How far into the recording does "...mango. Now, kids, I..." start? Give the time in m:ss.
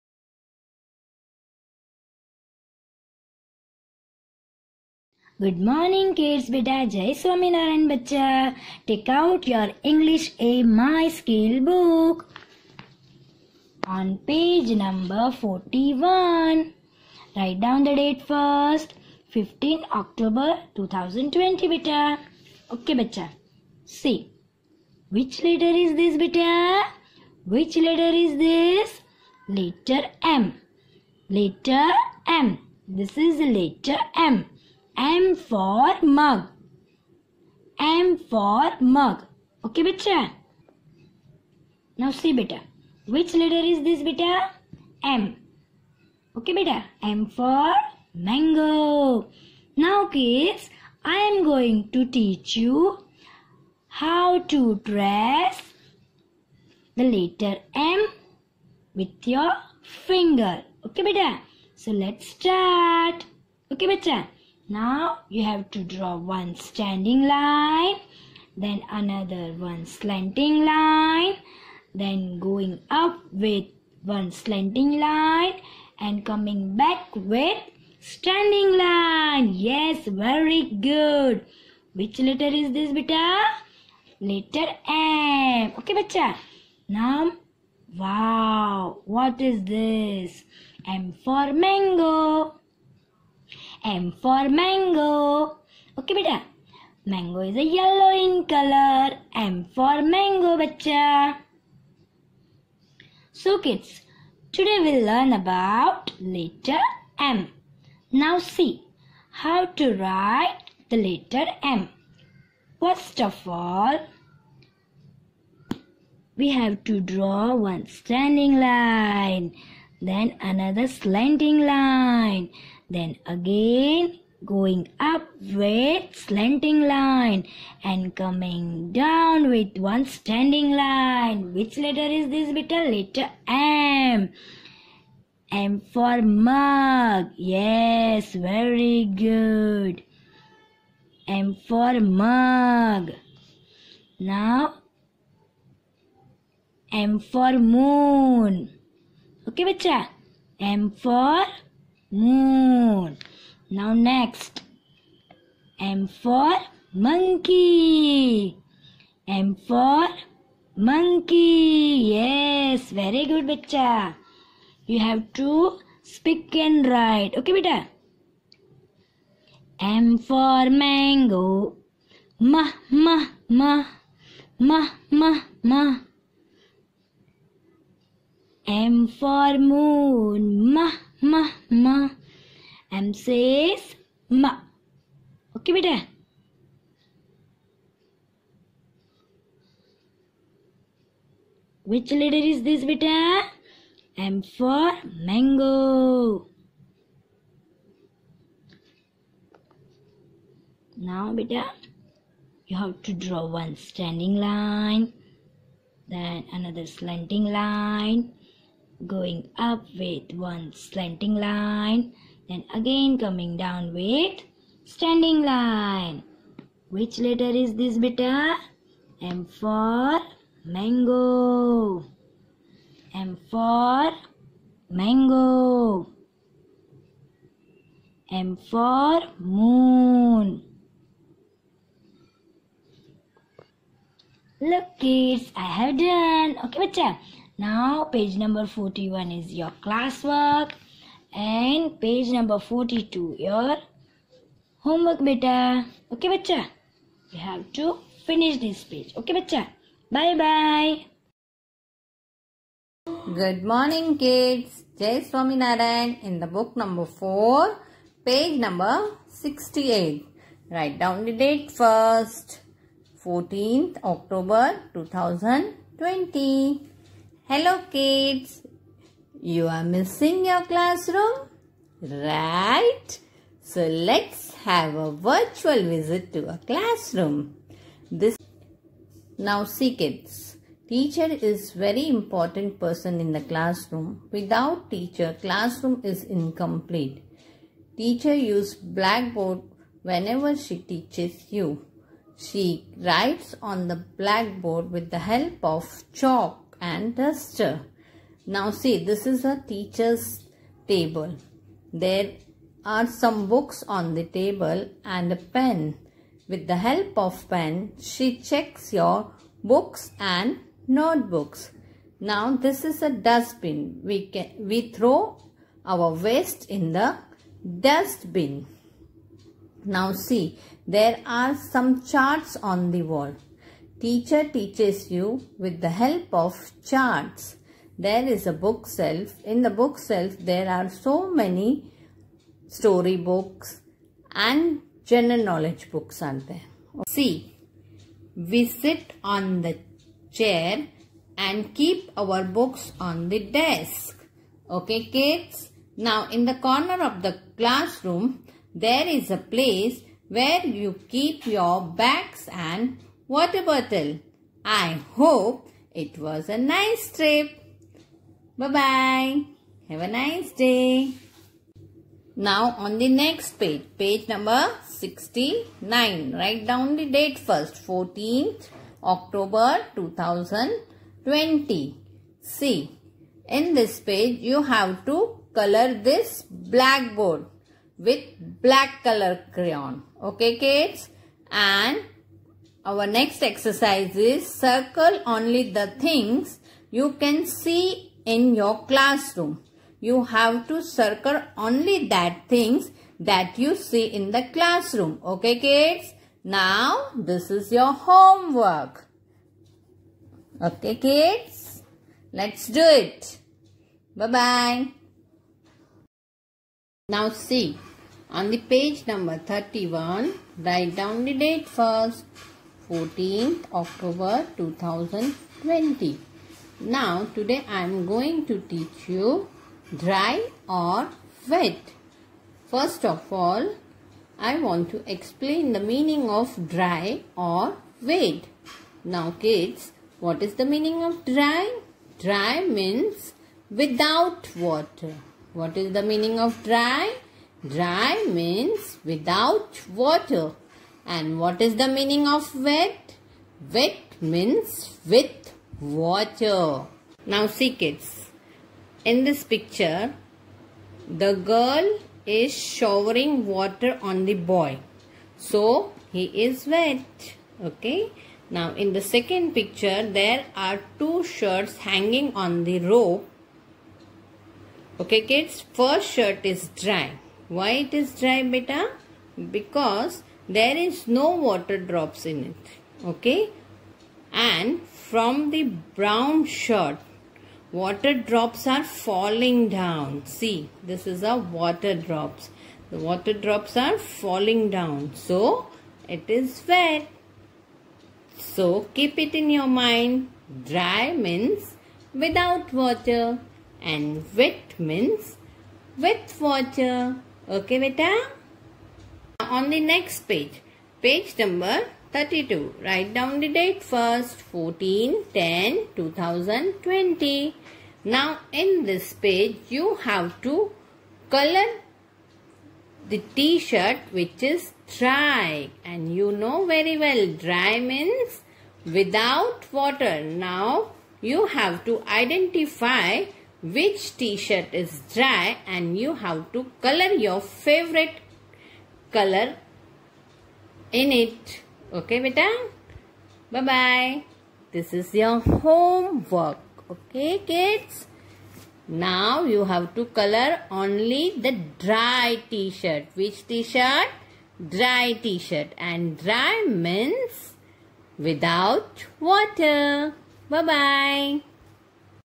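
0:48.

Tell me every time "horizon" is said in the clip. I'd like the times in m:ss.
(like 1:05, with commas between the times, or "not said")
not said.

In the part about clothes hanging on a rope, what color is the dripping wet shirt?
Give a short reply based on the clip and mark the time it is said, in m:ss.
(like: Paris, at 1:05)
Brown, at 7:55.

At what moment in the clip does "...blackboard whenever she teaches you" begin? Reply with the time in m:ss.
4:48.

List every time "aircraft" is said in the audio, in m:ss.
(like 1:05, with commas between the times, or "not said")
not said.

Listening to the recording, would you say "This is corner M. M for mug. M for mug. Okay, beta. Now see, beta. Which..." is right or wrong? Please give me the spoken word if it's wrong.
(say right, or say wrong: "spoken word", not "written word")
wrong: "letter", not "corner".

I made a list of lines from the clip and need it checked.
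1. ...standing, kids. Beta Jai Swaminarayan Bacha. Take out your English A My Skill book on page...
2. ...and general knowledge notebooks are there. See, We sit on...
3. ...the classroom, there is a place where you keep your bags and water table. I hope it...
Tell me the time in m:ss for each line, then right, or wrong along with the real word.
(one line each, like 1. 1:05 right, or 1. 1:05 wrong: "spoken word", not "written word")
1. 0:05 wrong: "morning", not "standing"
2. 5:34 wrong: "books", not "notebooks"
3. 5:47 wrong: "bottle", not "table".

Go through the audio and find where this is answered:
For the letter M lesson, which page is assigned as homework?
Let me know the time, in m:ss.
4:02.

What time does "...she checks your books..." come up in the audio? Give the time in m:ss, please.
5:08.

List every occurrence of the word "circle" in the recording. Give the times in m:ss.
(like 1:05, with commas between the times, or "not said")
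6:24, 6:30.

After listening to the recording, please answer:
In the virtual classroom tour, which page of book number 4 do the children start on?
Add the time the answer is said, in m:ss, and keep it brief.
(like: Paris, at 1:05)
68, at 4:18.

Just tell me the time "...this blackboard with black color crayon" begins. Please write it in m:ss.
6:16.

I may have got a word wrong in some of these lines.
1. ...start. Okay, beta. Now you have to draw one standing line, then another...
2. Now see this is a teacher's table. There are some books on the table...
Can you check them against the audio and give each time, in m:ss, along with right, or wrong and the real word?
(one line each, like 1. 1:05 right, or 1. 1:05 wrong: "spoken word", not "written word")
1. 1:02 right
2. 4:58 right.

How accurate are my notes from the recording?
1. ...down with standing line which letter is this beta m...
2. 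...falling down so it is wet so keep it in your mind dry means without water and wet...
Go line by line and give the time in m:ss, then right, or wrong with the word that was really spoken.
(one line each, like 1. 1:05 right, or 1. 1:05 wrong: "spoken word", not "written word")
1. 3:33 right
2. 8:04 right.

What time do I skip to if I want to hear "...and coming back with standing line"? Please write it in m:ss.
1:15.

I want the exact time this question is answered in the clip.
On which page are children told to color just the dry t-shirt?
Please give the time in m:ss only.
8:21.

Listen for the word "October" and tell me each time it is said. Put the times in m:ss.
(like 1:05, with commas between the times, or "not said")
0:20, 4:24, 6:09, 6:53.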